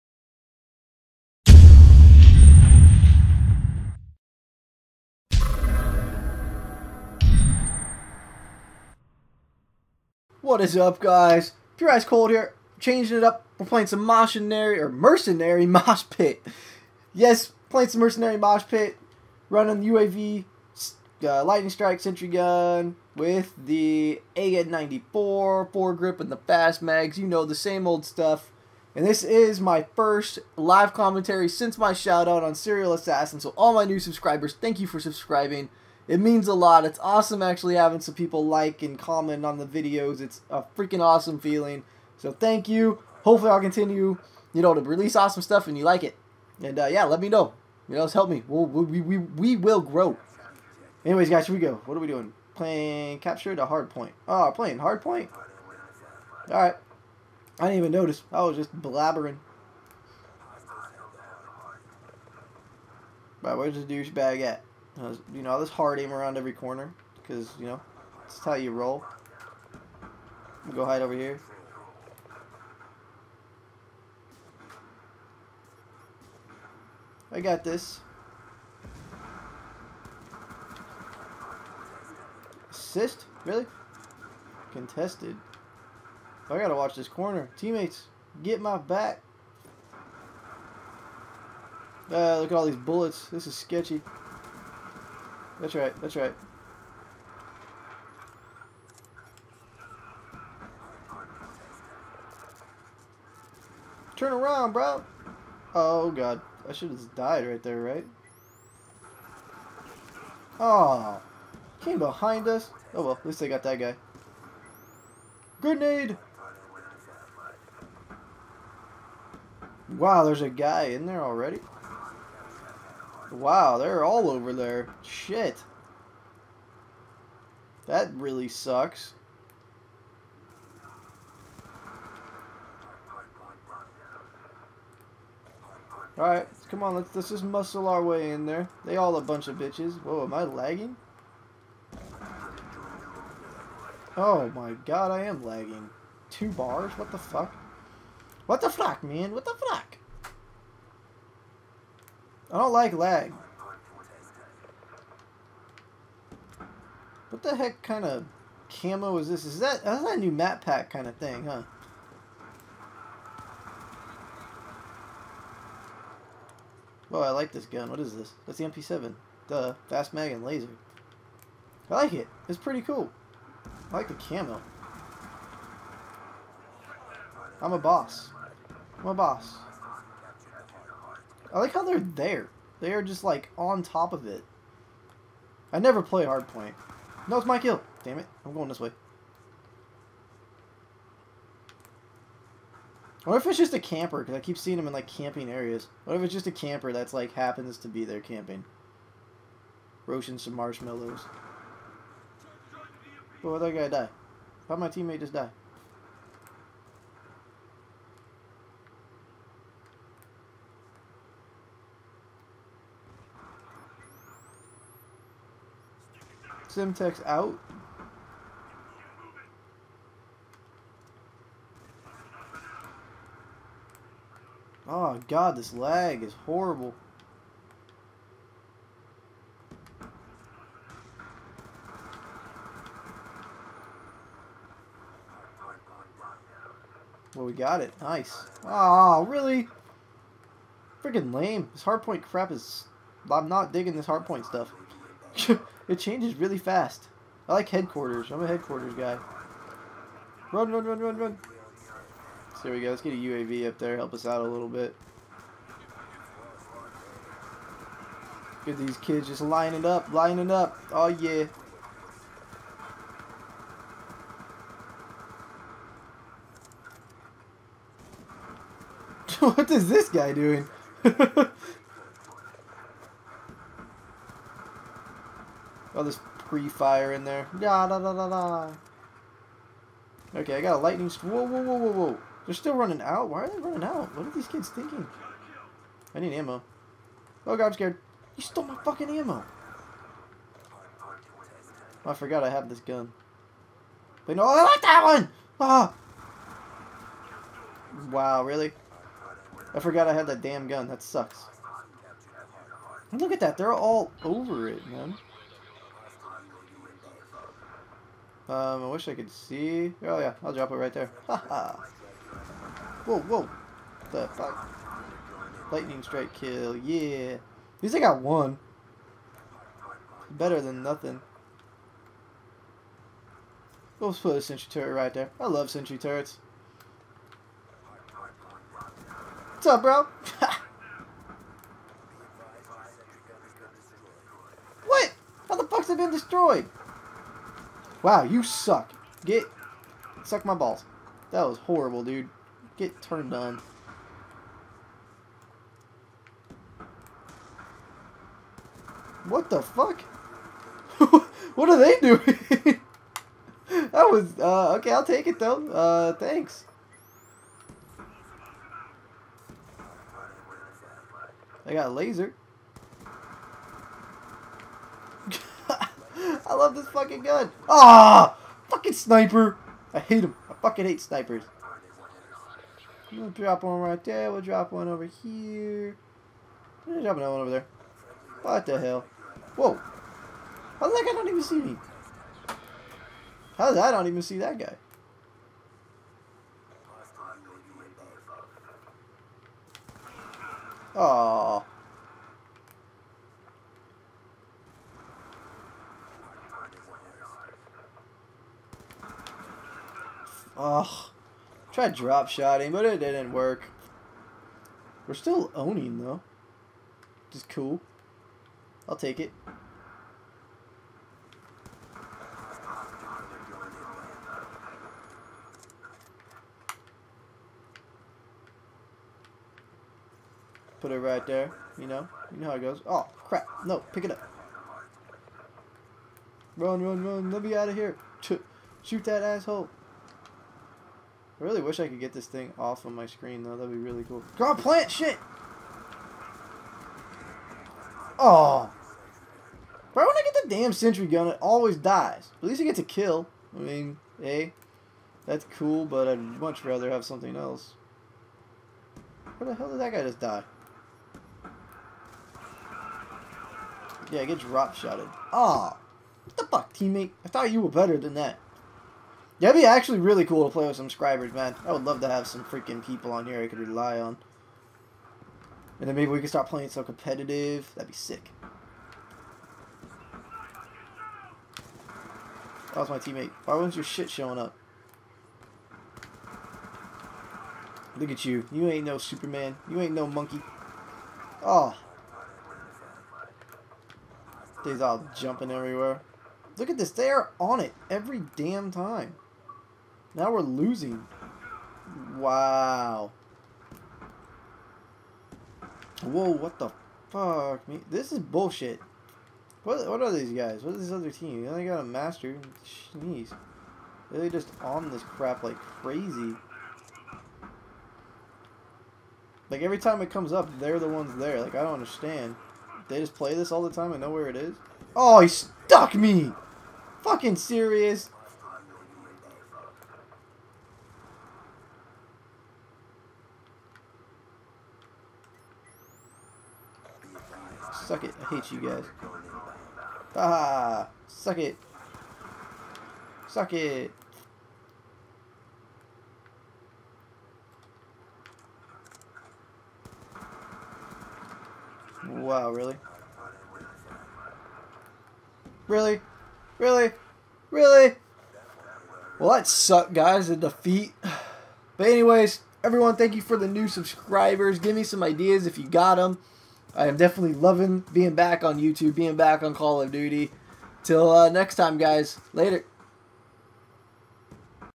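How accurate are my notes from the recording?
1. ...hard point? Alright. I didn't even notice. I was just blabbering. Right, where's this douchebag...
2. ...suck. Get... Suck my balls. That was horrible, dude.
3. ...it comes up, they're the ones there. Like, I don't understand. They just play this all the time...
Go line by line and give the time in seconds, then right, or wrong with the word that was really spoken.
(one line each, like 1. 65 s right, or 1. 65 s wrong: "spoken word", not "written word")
1. 54 s right
2. 338 s right
3. 510 s right.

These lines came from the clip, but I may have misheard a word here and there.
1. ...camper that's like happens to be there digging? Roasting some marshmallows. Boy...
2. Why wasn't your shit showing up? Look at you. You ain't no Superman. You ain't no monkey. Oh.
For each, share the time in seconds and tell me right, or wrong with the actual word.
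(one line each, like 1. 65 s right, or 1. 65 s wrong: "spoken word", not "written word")
1. 196 s wrong: "camping", not "digging"
2. 473 s right.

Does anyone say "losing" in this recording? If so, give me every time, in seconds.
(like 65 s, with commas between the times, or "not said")
490 s.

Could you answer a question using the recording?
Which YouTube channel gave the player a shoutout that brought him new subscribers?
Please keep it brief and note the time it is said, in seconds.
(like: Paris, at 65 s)
Serial Assassin, at 32 s.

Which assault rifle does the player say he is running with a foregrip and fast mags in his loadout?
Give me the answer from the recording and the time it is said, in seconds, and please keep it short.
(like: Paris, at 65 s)
AN-94, at 24 s.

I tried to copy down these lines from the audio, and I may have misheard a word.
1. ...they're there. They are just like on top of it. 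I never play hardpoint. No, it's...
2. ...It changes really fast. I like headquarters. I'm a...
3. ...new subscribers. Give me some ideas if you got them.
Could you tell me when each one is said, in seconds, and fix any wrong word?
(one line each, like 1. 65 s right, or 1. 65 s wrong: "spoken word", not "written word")
1. 181 s right
2. 245 s right
3. 553 s right.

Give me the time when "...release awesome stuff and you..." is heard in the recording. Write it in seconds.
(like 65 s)
44 s.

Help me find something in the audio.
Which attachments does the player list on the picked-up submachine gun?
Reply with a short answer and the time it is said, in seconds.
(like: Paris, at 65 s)
fast mag and laser, at 169 s.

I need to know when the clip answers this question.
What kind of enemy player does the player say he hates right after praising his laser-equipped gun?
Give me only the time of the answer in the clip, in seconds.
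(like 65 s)
368 s.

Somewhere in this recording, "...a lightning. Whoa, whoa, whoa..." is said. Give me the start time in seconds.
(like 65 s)
280 s.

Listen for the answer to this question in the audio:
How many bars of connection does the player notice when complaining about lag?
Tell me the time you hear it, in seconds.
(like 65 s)
146 s.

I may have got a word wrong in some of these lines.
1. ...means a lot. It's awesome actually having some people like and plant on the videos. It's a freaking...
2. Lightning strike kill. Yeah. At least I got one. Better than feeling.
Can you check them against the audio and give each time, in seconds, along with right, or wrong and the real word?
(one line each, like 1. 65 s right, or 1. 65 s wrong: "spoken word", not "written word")
1. 36 s wrong: "comment", not "plant"
2. 315 s wrong: "nothing", not "feeling".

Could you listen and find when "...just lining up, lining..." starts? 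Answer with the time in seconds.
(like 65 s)
259 s.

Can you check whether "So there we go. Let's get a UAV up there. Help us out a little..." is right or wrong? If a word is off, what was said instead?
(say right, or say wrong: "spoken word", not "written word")
right.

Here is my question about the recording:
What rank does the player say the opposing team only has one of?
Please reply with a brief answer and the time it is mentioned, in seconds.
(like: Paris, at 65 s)
Master, at 501 s.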